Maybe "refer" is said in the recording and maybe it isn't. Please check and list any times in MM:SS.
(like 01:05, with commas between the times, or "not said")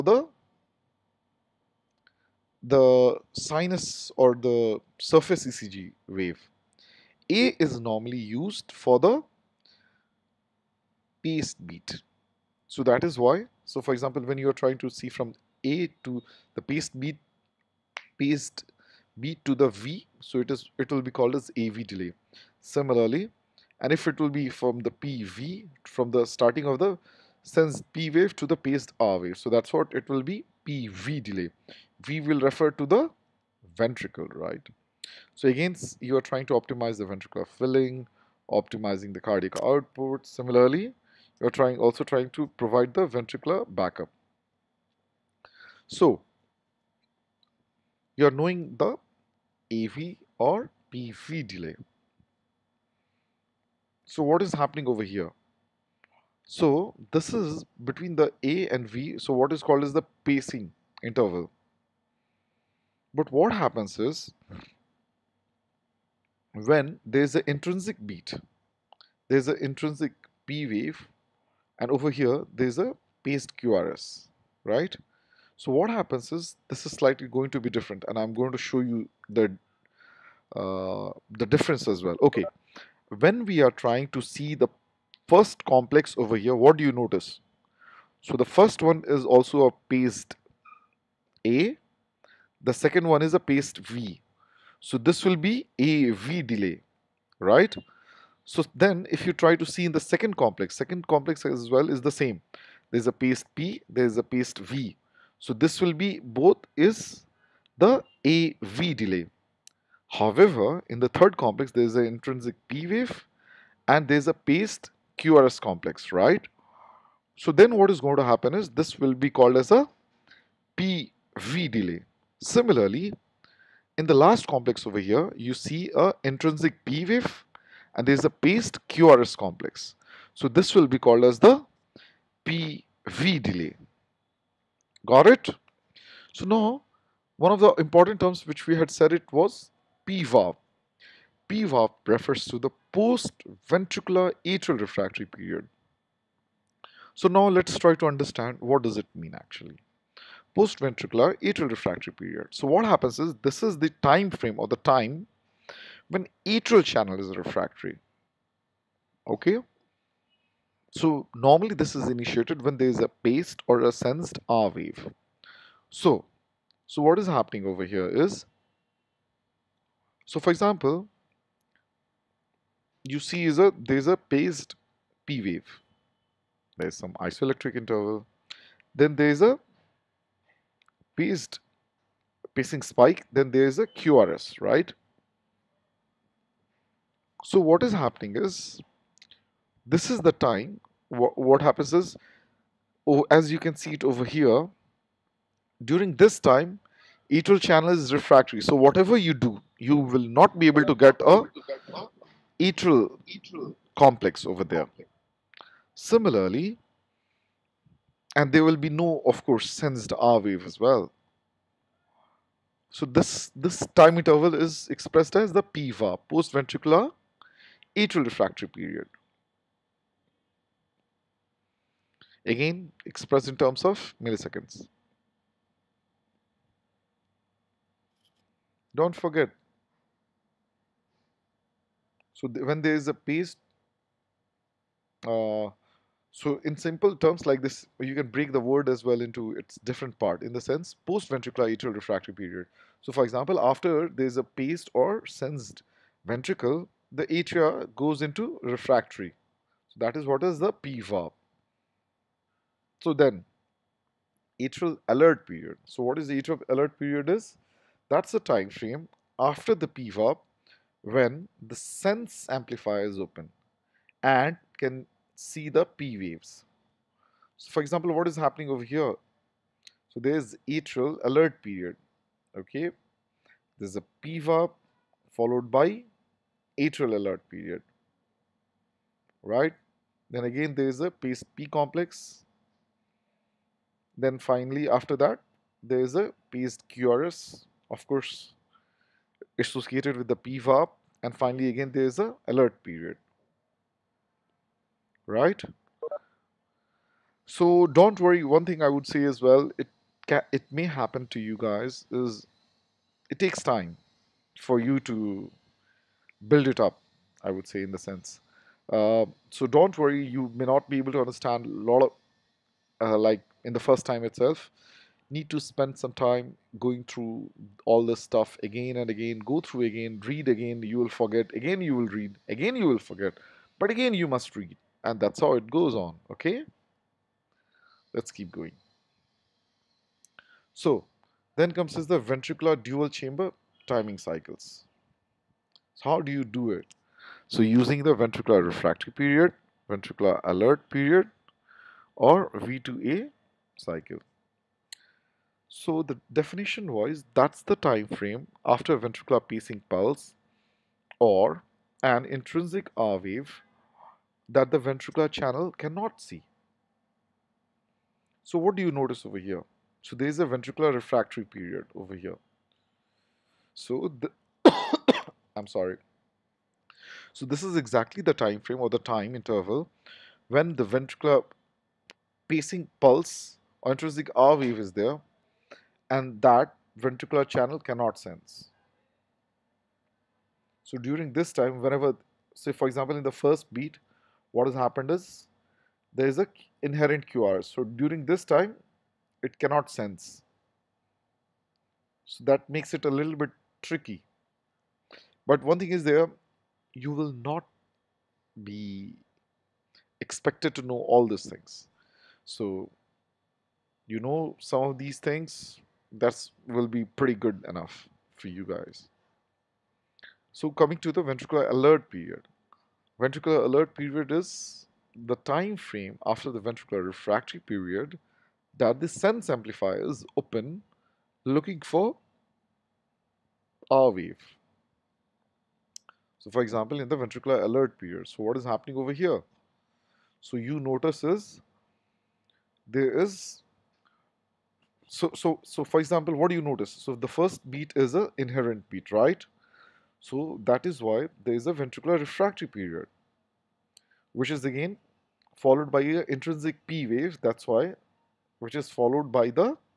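00:32, 02:22.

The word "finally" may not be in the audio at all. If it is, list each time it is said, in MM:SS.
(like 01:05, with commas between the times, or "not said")
04:44, 04:51.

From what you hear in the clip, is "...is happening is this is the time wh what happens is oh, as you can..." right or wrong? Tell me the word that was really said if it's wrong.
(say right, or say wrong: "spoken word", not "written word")
right.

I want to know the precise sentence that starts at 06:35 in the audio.
But one thing is there, you will not be expected to know all these things.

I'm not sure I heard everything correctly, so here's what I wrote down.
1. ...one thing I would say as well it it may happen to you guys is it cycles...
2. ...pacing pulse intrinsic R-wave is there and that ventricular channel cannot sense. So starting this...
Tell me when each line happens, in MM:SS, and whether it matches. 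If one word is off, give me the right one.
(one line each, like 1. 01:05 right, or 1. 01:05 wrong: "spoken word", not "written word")
1. 04:58 wrong: "takes", not "cycles"
2. 06:12 wrong: "during", not "starting".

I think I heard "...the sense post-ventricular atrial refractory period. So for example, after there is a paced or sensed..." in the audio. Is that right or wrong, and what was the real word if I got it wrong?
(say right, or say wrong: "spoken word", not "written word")
right.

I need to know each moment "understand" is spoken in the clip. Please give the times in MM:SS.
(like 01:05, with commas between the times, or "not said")
02:28, 05:11.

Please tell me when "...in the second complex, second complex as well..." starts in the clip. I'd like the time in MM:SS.
01:39.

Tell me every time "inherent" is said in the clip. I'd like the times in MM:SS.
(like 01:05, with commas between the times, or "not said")
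06:26, 07:18.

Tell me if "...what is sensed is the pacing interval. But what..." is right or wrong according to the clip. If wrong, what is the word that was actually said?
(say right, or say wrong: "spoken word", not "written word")
wrong: "called", not "sensed".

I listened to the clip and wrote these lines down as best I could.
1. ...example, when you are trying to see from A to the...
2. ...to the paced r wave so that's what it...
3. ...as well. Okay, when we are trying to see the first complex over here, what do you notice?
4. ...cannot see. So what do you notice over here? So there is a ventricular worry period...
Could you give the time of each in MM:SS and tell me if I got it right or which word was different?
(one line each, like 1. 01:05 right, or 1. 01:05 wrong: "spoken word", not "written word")
1. 00:13 right
2. 00:28 right
3. 01:21 right
4. 05:55 wrong: "refractory", not "worry".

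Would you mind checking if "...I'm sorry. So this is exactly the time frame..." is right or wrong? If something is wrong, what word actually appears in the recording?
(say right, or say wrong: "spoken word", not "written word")
right.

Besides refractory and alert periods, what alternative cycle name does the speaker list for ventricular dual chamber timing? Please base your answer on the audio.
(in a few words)
V2A cycle.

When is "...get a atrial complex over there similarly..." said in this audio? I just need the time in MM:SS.
03:21.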